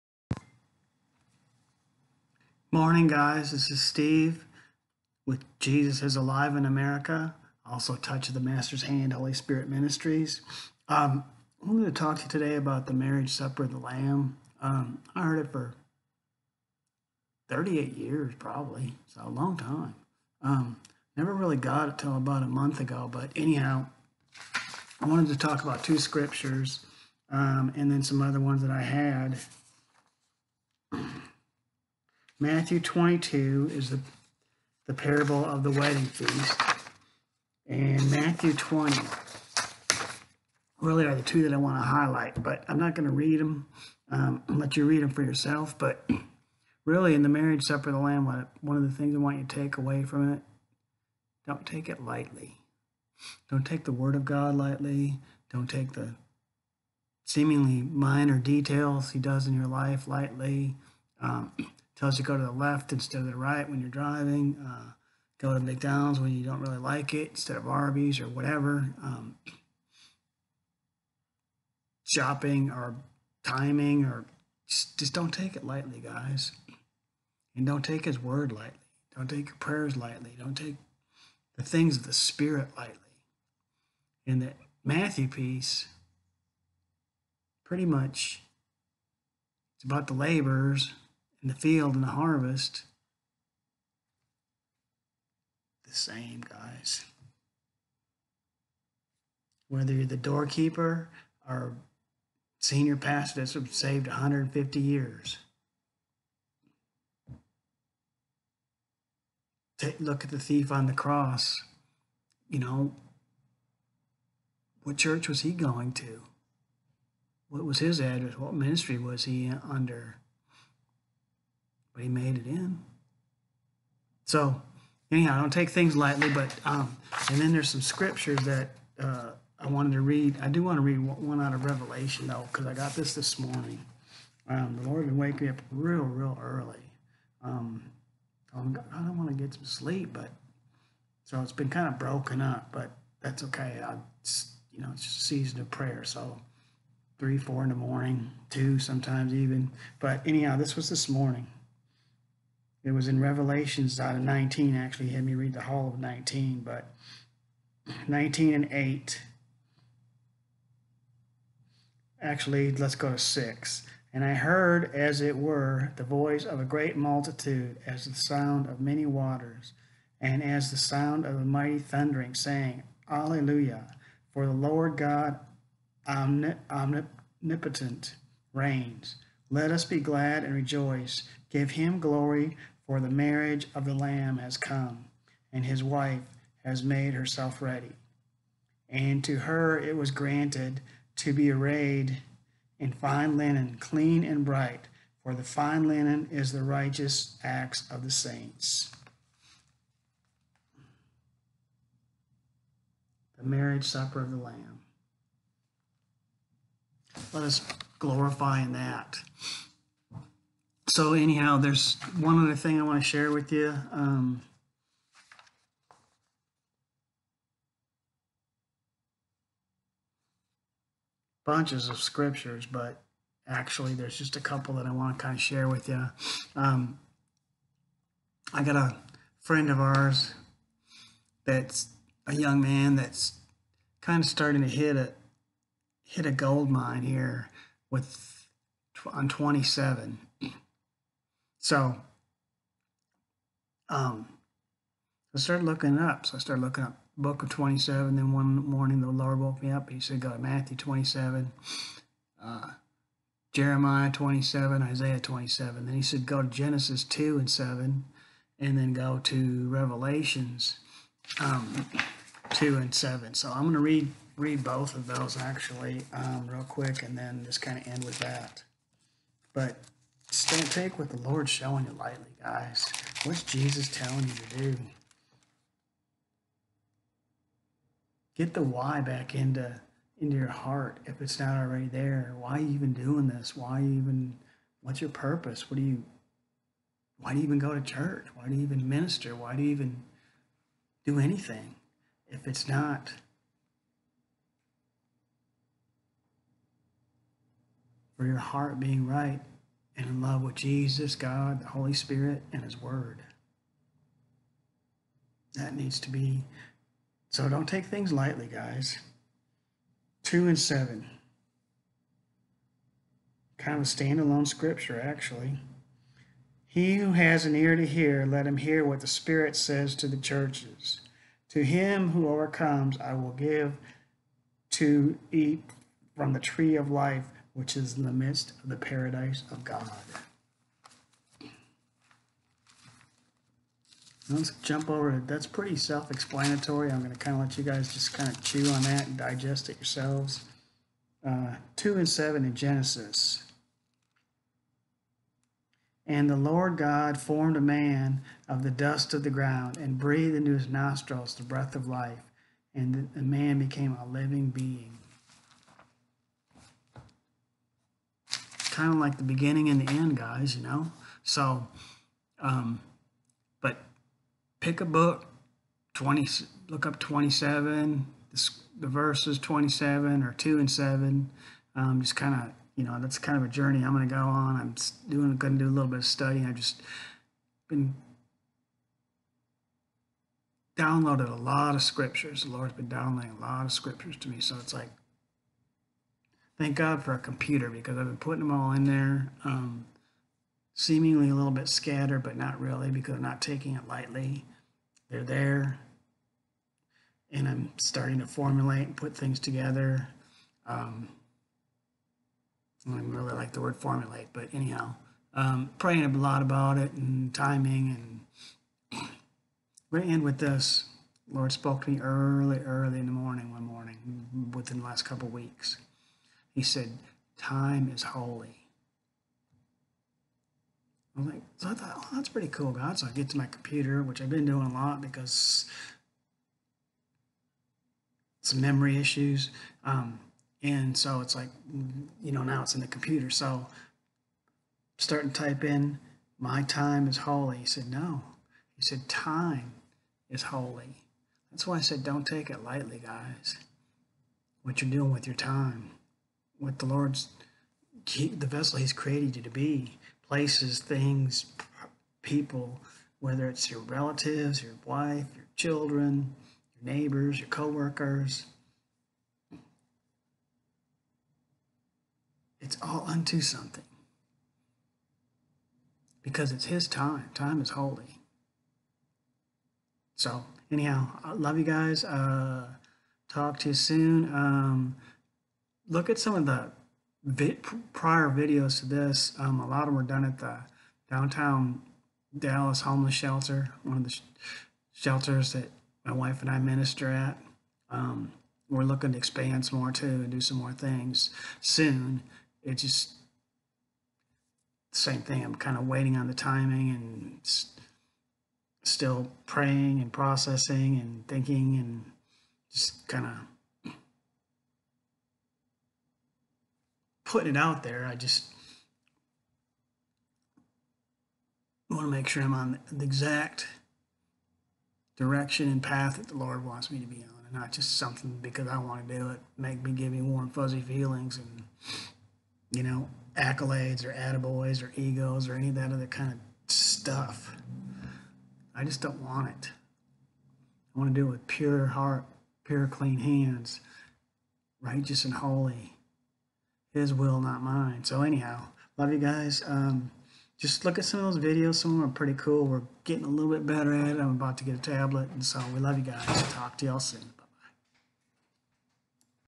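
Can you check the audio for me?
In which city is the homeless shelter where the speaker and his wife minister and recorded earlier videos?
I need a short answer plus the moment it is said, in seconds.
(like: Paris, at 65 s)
Dallas, at 482 s.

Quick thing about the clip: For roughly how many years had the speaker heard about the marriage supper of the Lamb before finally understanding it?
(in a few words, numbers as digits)
38.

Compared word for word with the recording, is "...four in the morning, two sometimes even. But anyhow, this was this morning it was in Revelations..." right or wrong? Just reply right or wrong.
right.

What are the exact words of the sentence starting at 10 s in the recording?
Um, I wanted to talk to you today about the marriage supper of the Lamb.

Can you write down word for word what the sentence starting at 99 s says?
Whether you're the doorkeeper or senior pastor that's saved 150 years.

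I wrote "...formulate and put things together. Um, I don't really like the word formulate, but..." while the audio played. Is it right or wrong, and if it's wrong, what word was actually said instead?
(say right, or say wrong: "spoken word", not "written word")
right.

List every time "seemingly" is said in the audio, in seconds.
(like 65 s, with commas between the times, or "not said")
57 s, 390 s.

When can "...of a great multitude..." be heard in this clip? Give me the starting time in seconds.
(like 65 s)
166 s.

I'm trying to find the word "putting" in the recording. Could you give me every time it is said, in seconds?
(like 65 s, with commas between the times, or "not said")
388 s, 507 s.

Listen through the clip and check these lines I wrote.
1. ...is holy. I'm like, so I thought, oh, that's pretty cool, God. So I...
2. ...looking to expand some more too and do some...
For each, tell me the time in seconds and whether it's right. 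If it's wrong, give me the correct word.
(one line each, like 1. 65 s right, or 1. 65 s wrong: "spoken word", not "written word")
1. 417 s right
2. 488 s right.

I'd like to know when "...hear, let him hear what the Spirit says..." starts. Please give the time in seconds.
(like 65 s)
317 s.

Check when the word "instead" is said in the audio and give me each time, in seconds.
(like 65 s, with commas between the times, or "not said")
62 s, 67 s.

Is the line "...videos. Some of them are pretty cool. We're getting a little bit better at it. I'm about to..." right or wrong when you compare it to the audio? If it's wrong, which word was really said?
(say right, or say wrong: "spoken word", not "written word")
right.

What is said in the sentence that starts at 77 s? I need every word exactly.
And don't take his word lightly.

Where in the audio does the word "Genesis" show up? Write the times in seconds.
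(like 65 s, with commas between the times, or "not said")
256 s, 342 s.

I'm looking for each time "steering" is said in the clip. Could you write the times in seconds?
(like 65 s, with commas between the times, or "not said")
not said.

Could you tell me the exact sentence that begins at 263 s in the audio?
So I'm going to read read both of those actually um, real quick and then just kind of end with that.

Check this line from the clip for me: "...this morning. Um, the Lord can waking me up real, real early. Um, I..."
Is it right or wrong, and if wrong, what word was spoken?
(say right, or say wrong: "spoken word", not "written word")
right.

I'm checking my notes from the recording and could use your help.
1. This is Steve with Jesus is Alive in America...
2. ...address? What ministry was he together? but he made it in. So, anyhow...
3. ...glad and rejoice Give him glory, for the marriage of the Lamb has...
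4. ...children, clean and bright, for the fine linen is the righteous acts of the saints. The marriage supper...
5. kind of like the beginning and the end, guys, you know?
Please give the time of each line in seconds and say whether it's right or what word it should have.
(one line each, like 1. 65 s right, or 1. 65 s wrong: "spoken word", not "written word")
1. 3 s right
2. 117 s wrong: "under", not "together"
3. 179 s right
4. 193 s wrong: "linen", not "children"
5. 358 s right.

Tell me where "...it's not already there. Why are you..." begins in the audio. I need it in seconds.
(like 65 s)
281 s.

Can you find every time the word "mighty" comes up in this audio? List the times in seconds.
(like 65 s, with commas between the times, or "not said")
171 s.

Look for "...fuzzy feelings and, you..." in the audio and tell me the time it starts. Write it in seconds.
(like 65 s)
520 s.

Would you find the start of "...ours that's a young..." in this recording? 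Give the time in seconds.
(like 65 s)
229 s.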